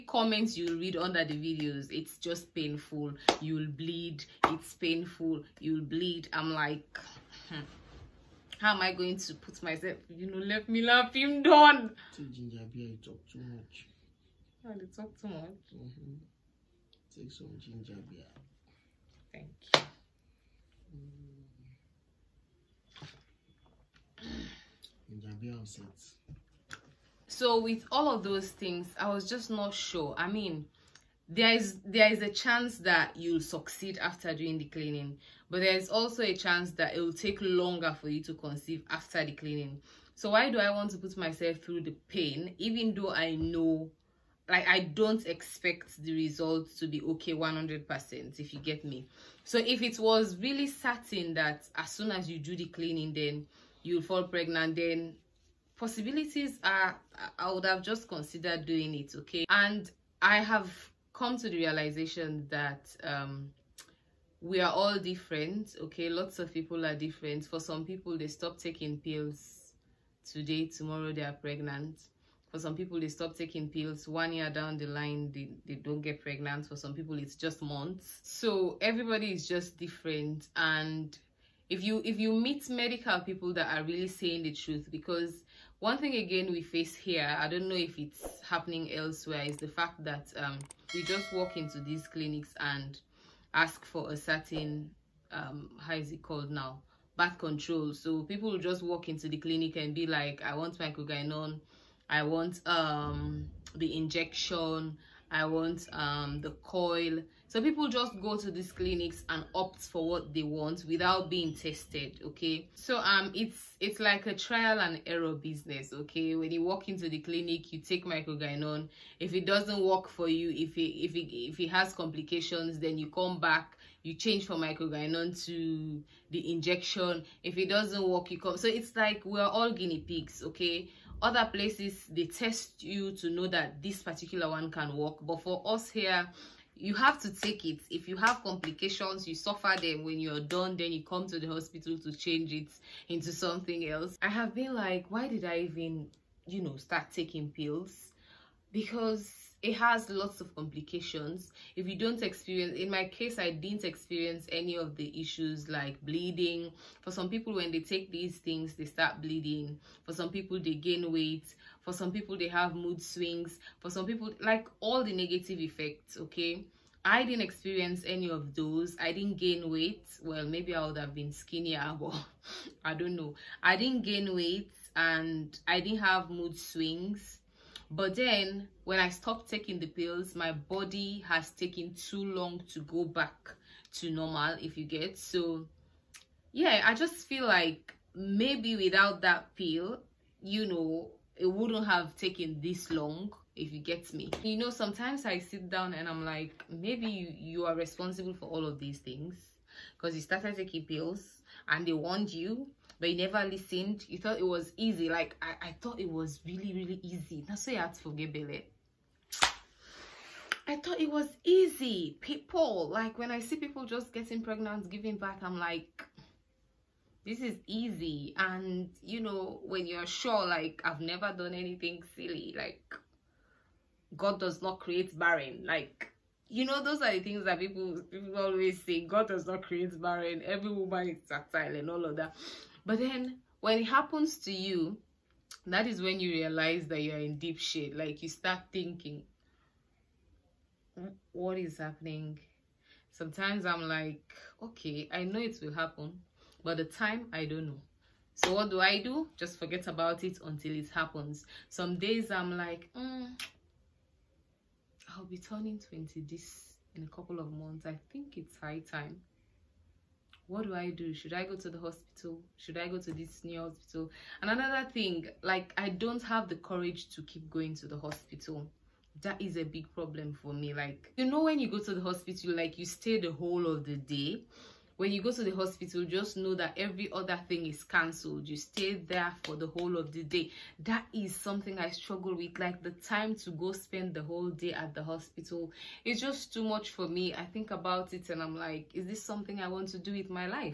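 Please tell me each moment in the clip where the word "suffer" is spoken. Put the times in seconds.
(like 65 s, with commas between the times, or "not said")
139 s.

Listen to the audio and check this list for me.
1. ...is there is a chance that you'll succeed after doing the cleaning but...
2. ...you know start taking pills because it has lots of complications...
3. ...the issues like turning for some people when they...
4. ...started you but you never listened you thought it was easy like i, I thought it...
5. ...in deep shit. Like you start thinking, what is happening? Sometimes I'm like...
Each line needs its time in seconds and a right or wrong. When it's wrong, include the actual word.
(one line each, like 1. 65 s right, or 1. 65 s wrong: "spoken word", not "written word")
1. 31 s right
2. 146 s right
3. 154 s wrong: "bleeding", not "turning"
4. 201 s wrong: "warned", not "started"
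5. 237 s right.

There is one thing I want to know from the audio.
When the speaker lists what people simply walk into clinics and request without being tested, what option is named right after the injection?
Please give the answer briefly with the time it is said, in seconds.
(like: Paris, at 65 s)
the coil, at 106 s.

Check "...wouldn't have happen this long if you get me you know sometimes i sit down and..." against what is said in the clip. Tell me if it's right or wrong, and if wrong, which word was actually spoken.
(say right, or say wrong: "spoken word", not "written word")
wrong: "taken", not "happen".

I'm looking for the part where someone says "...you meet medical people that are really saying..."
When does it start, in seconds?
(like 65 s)
82 s.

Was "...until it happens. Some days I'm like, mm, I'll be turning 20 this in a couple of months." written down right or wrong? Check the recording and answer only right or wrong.
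right.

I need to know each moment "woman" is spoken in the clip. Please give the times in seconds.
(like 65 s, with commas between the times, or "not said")
230 s.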